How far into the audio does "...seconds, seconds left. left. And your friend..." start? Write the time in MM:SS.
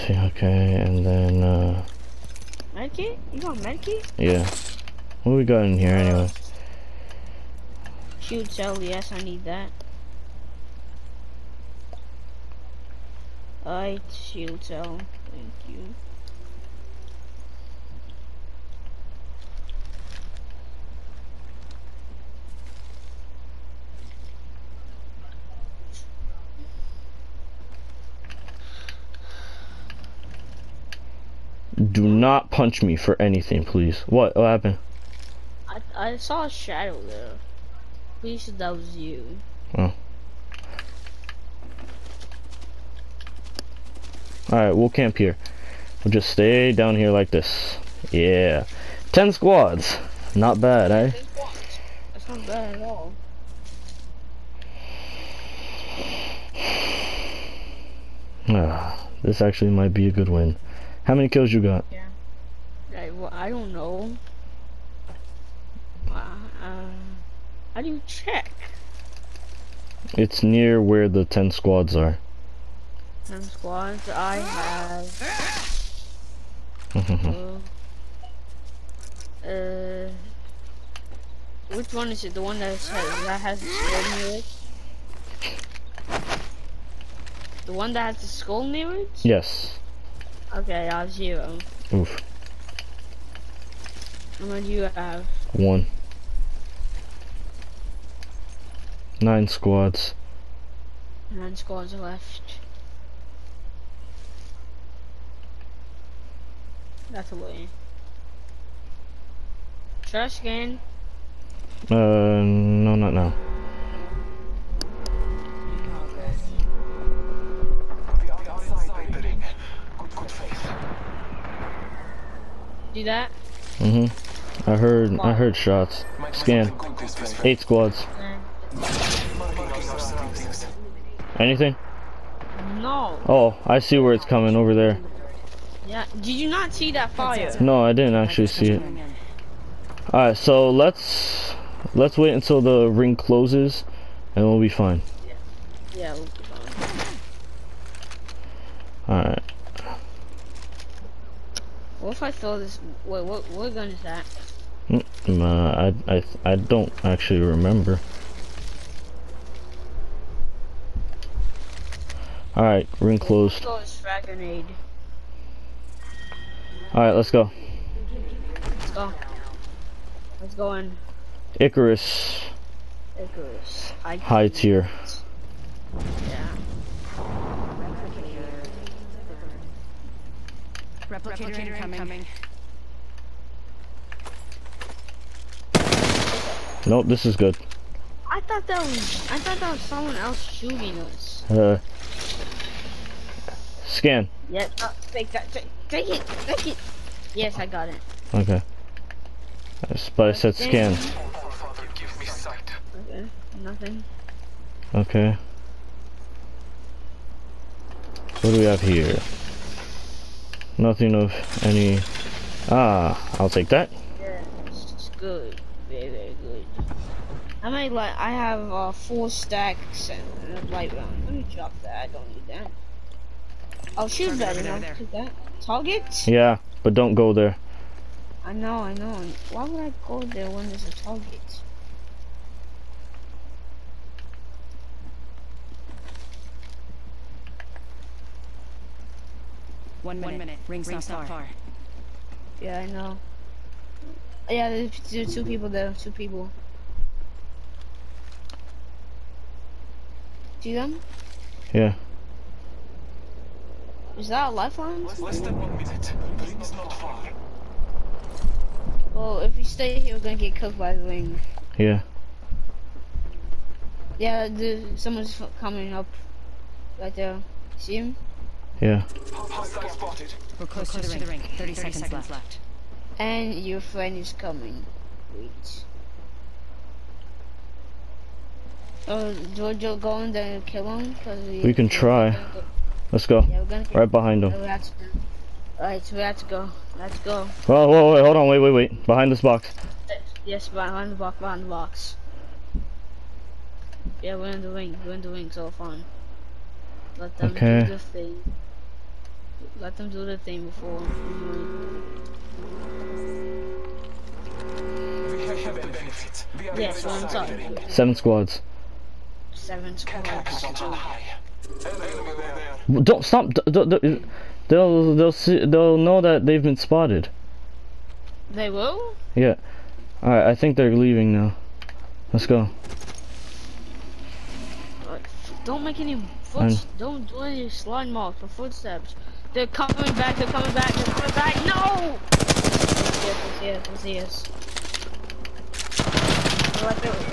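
04:31.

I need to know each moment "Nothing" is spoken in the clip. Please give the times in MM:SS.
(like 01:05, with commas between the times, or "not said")
03:23, 03:30.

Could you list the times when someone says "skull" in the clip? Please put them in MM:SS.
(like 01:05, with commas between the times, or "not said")
01:23, 01:28.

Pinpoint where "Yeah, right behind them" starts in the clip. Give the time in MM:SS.
04:43.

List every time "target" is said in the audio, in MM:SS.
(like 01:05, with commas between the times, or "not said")
03:45, 03:50.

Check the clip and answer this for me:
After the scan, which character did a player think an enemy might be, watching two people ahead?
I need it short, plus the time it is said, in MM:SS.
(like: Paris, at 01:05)
Lifeline, at 04:14.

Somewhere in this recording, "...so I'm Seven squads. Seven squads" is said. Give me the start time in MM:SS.
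05:06.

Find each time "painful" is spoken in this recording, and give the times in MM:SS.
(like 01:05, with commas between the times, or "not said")
not said.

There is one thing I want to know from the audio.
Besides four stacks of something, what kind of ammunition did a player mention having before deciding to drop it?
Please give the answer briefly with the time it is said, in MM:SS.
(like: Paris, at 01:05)
light round, at 03:40.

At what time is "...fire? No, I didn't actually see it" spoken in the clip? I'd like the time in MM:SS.
02:17.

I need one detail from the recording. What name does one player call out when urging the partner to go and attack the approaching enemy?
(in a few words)
George.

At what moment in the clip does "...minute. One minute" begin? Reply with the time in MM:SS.
04:00.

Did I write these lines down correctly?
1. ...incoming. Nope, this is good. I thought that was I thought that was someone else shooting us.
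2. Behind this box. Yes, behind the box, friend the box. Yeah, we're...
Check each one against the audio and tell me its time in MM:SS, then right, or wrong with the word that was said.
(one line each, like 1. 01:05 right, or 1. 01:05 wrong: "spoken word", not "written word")
1. 03:01 right
2. 04:49 wrong: "behind", not "friend".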